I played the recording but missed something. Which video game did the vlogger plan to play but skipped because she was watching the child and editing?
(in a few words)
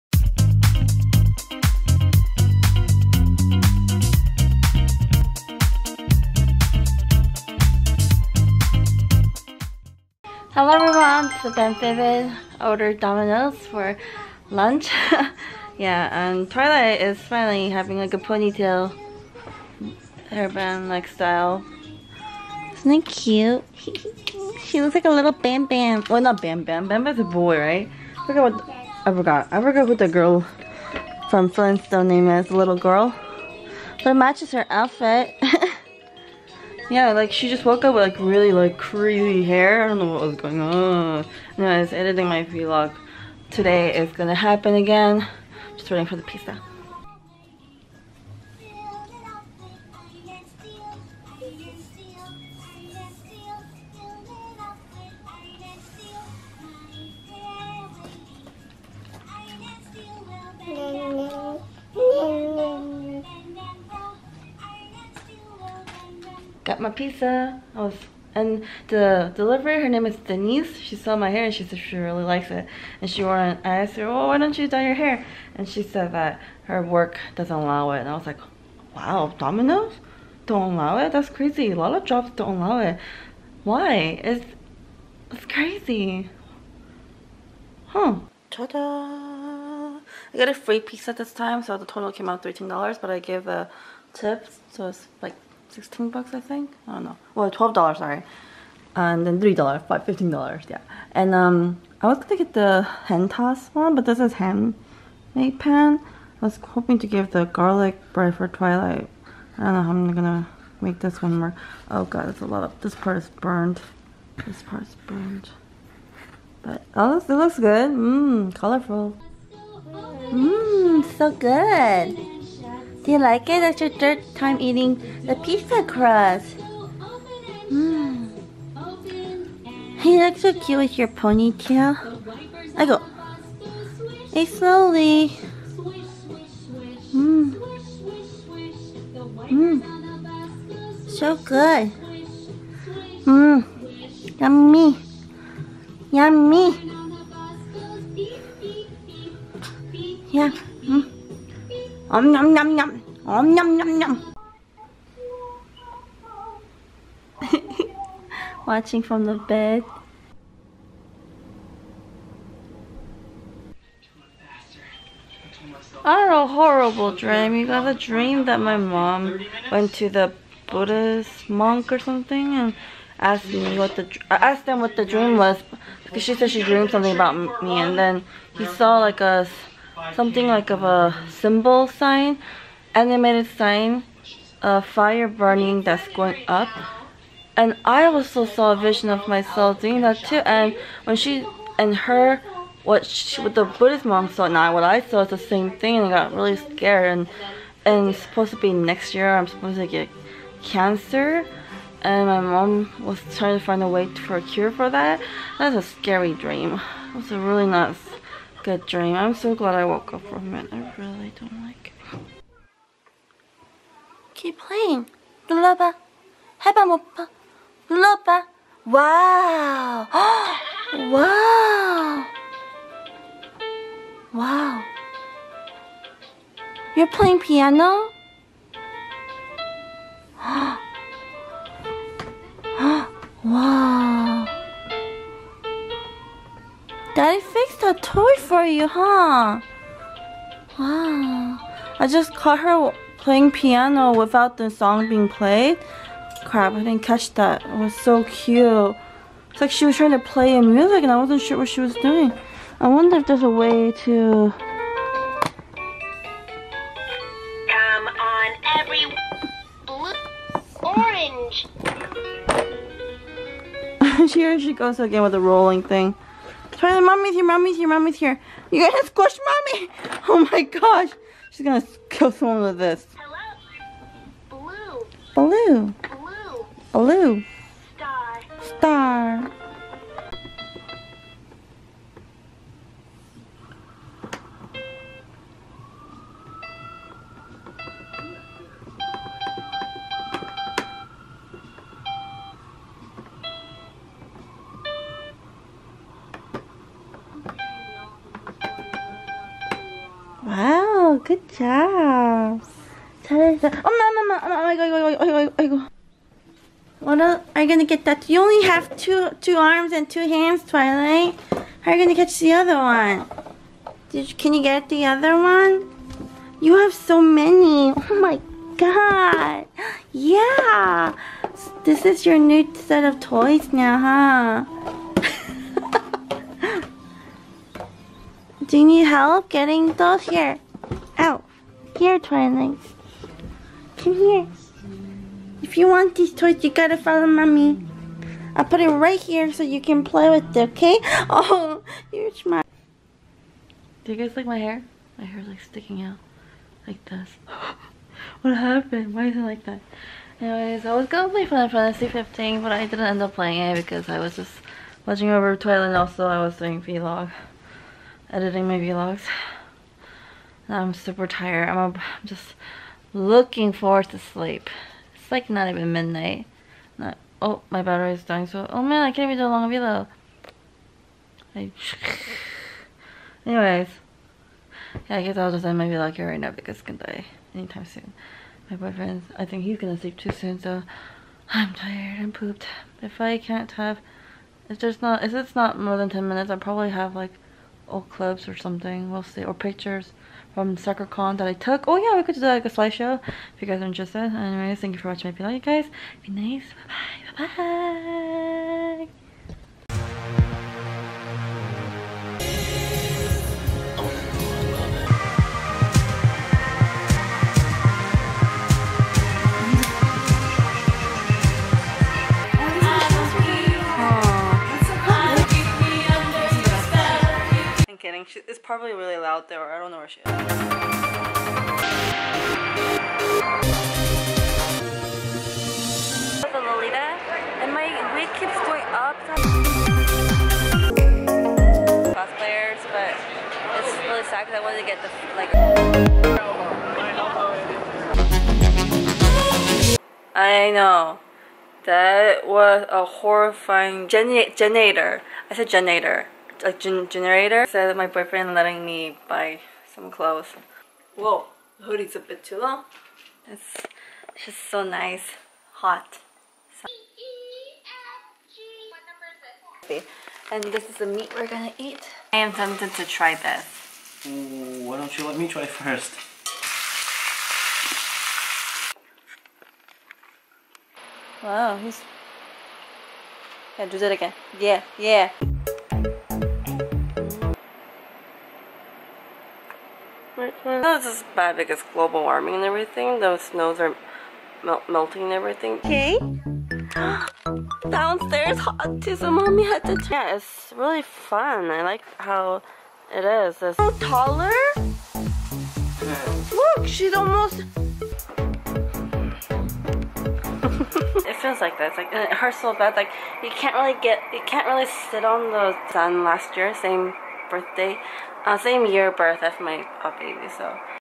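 Final Fantasy 15.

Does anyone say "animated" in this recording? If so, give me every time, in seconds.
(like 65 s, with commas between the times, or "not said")
182 s.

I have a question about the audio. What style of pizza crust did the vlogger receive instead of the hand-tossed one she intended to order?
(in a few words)
handmade pan.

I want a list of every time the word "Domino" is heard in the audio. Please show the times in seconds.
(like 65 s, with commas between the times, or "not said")
12 s, 79 s.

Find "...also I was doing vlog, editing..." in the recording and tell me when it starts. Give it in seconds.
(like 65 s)
355 s.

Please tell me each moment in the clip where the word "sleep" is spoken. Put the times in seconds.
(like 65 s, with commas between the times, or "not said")
364 s, 379 s.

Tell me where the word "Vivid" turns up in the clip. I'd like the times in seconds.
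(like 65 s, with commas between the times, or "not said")
11 s.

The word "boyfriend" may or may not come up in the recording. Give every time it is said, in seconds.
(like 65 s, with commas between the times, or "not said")
378 s, 448 s.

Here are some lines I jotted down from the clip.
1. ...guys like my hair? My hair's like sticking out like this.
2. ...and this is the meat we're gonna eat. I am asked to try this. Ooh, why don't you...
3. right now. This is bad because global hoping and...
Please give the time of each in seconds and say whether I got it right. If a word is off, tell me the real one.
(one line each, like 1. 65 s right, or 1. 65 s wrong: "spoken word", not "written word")
1. 344 s right
2. 460 s wrong: "tempted", not "asked"
3. 480 s wrong: "warming", not "hoping".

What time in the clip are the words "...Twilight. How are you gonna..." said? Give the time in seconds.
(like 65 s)
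310 s.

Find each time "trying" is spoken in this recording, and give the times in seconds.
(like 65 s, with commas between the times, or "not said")
203 s, 249 s.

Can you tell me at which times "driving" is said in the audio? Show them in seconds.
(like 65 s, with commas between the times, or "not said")
418 s.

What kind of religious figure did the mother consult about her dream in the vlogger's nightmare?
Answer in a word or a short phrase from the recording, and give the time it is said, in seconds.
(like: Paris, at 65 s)
Buddhist monk, at 170 s.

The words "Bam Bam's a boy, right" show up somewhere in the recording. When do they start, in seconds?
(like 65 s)
26 s.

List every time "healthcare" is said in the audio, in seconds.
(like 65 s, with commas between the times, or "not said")
not said.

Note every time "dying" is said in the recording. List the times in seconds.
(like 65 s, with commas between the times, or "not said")
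368 s.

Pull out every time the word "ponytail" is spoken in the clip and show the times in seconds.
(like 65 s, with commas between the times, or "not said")
18 s, 131 s.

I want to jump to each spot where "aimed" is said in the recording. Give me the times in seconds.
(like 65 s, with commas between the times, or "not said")
not said.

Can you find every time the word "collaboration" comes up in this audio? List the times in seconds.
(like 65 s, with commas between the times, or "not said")
not said.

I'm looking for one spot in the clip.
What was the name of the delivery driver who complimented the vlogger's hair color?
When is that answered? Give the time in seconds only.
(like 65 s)
70 s.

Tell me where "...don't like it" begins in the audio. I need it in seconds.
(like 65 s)
211 s.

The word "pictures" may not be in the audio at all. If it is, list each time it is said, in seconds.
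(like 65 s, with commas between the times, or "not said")
389 s.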